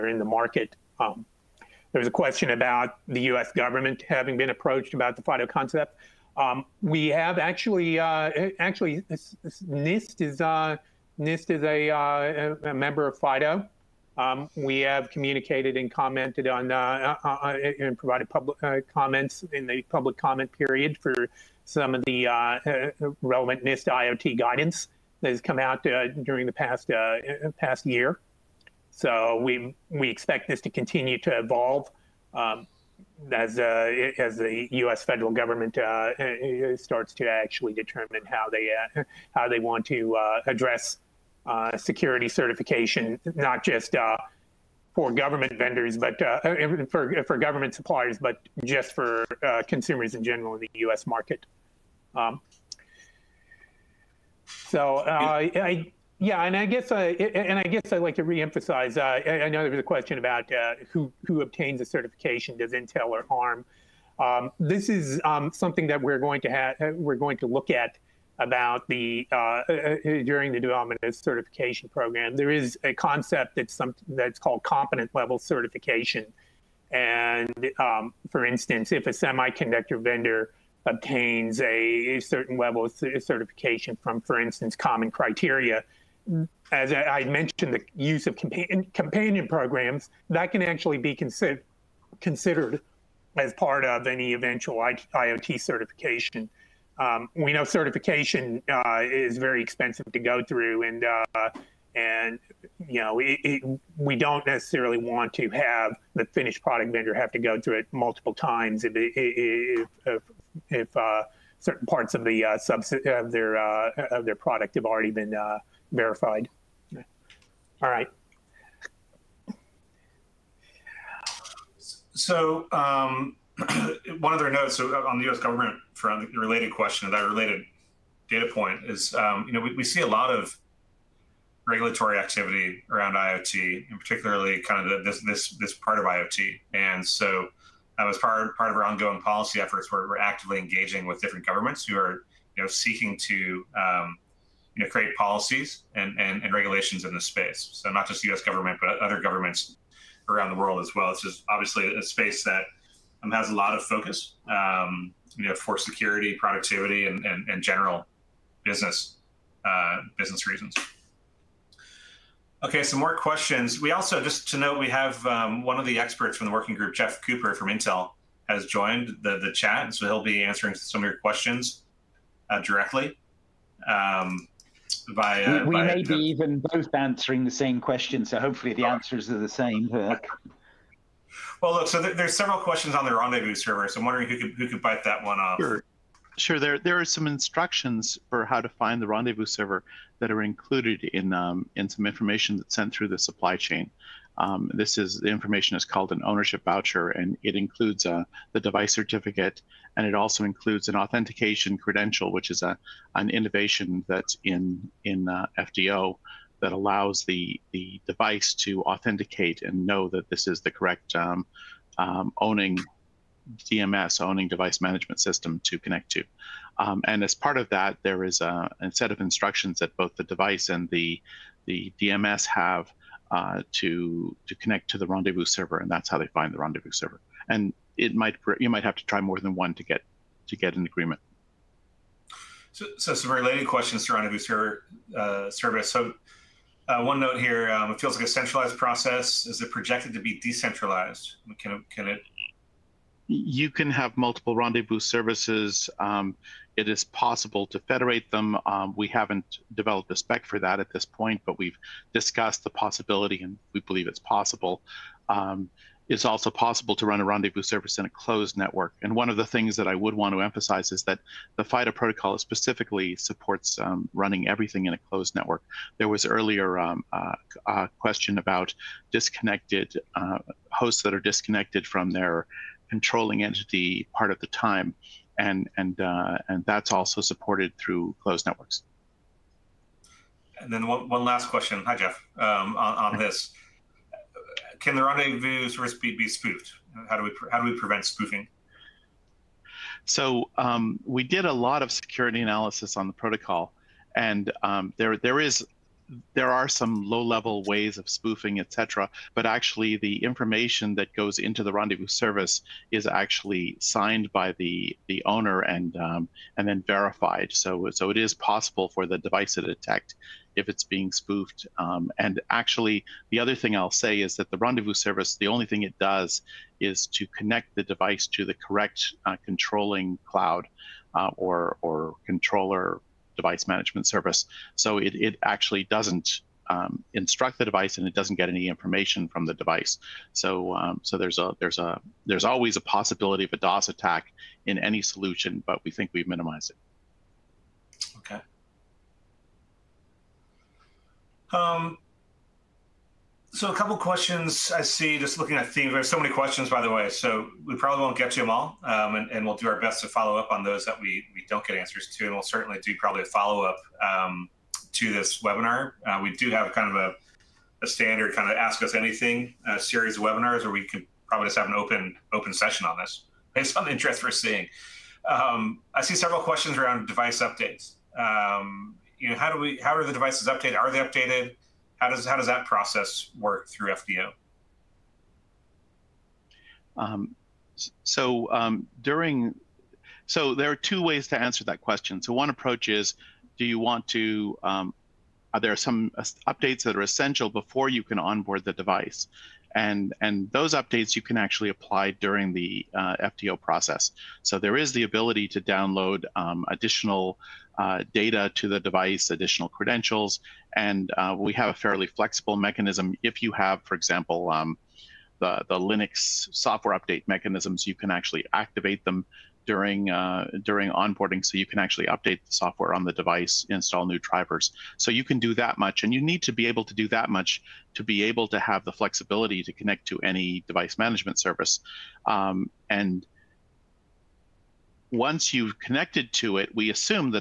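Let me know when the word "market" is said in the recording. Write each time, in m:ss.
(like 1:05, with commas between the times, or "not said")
0:00, 0:51.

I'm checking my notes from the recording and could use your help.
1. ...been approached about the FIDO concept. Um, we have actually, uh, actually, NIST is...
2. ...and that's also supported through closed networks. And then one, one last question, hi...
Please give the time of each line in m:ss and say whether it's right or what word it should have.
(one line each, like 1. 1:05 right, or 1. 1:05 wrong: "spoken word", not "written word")
1. 0:04 right
2. 4:36 right.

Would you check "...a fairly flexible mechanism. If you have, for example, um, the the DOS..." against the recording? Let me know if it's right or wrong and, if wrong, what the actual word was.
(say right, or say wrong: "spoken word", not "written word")
wrong: "Linux", not "DOS".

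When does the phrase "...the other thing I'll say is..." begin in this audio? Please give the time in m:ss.
5:13.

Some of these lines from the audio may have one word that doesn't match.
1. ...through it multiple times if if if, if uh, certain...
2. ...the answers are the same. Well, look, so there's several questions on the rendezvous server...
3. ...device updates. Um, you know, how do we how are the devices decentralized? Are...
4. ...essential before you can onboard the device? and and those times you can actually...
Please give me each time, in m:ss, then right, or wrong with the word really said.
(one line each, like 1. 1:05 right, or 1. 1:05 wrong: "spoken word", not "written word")
1. 1:47 right
2. 2:58 right
3. 6:07 wrong: "updated", not "decentralized"
4. 6:27 wrong: "updates", not "times".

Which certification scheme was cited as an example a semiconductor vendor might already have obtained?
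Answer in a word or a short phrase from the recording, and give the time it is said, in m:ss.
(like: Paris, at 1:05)
Common Criteria, at 1:24.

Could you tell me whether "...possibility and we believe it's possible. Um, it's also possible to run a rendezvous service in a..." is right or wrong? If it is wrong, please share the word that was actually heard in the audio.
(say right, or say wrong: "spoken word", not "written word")
right.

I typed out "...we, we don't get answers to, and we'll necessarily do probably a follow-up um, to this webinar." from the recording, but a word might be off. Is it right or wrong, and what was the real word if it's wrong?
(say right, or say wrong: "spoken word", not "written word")
wrong: "certainly", not "necessarily".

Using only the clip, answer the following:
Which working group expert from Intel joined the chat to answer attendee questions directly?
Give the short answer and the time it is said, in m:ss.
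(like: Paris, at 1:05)
Jeff Cooper, at 2:46.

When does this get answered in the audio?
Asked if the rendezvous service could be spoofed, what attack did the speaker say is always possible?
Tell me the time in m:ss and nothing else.
5:33.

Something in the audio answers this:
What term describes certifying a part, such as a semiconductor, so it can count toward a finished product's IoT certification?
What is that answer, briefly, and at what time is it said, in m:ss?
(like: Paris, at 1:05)
component level certification, at 1:14.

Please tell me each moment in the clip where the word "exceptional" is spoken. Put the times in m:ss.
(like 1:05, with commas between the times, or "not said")
not said.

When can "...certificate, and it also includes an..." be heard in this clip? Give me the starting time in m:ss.
3:18.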